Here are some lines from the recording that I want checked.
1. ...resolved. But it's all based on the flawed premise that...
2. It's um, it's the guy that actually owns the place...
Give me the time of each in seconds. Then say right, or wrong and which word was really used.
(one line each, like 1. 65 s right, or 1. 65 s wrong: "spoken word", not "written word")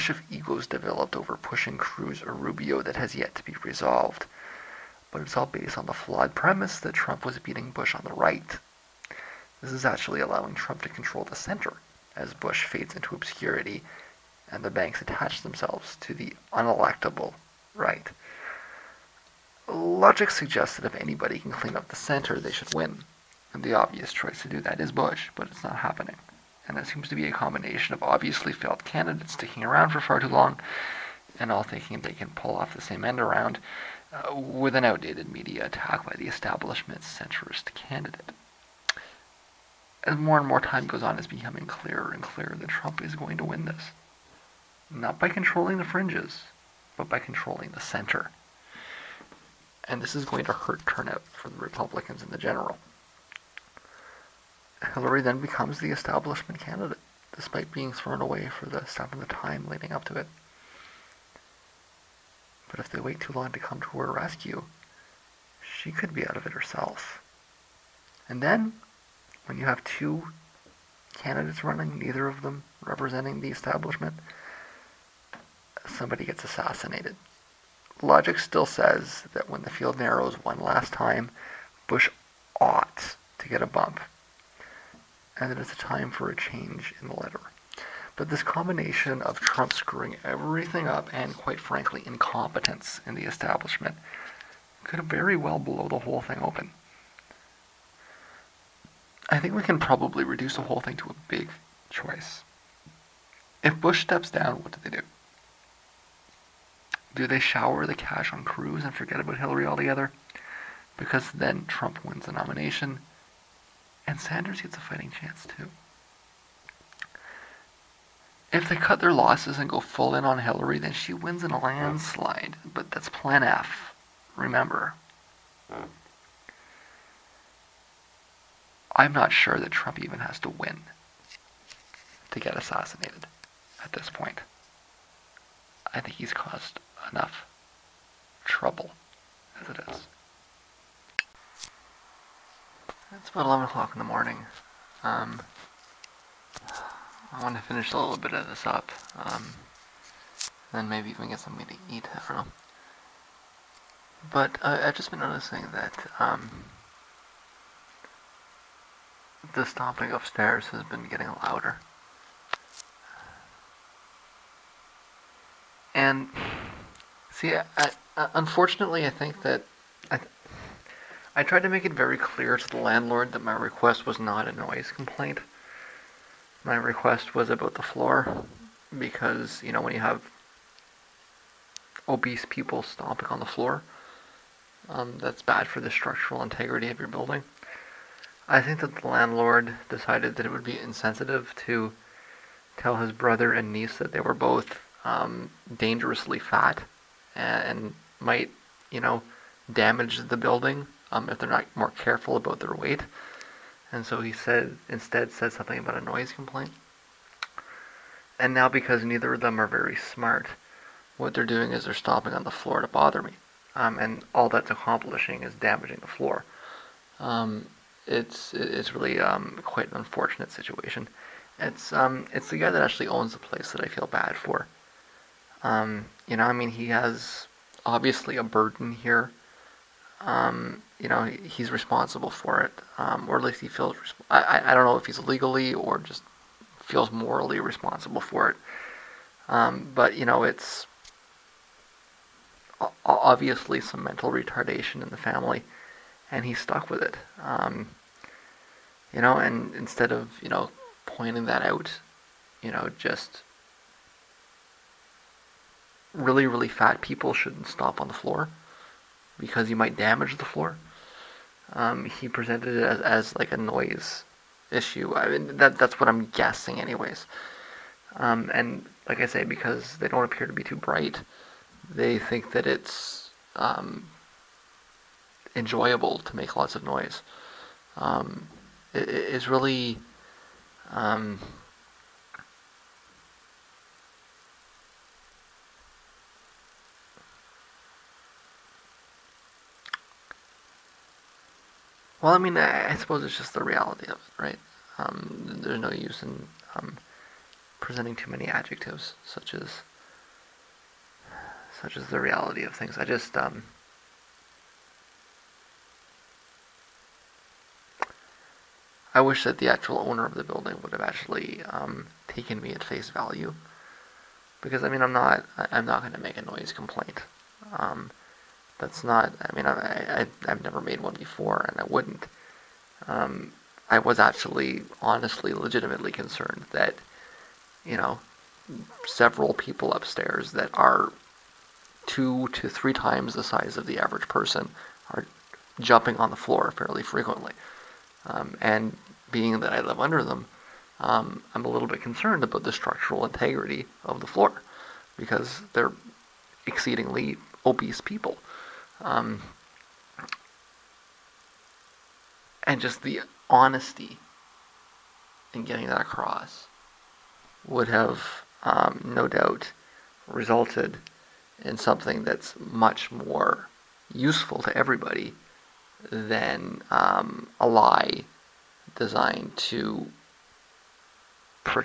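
1. 3 s right
2. 221 s right.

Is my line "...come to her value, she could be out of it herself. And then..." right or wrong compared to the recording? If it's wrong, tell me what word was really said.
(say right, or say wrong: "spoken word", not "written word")
wrong: "rescue", not "value".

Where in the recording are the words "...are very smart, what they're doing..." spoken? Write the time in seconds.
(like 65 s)
209 s.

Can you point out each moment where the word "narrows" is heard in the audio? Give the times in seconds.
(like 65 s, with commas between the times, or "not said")
79 s.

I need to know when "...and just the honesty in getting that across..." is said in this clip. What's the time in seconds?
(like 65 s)
352 s.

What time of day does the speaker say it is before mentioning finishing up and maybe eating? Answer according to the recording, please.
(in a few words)
11 o'clock.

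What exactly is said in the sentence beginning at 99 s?
I think we can probably reduce the whole thing to a big choice.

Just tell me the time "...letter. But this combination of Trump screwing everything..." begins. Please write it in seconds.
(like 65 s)
87 s.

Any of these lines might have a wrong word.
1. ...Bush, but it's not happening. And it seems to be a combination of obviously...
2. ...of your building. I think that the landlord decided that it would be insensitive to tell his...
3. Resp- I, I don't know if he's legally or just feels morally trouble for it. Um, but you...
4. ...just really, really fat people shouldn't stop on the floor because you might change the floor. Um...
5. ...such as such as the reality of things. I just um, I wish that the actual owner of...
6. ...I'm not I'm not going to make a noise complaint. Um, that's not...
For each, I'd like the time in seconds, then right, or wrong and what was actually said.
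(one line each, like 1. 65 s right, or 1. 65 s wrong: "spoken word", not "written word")
1. 24 s right
2. 186 s right
3. 233 s wrong: "responsible", not "trouble"
4. 252 s wrong: "damage", not "change"
5. 299 s right
6. 315 s right.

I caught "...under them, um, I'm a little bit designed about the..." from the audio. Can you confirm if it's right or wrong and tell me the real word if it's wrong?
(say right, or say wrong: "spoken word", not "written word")
wrong: "concerned", not "designed".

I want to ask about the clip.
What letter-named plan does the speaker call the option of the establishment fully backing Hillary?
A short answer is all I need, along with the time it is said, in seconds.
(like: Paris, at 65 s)
Plan F, at 123 s.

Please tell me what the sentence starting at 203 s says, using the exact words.
And so he said instead said something about a noise complaint.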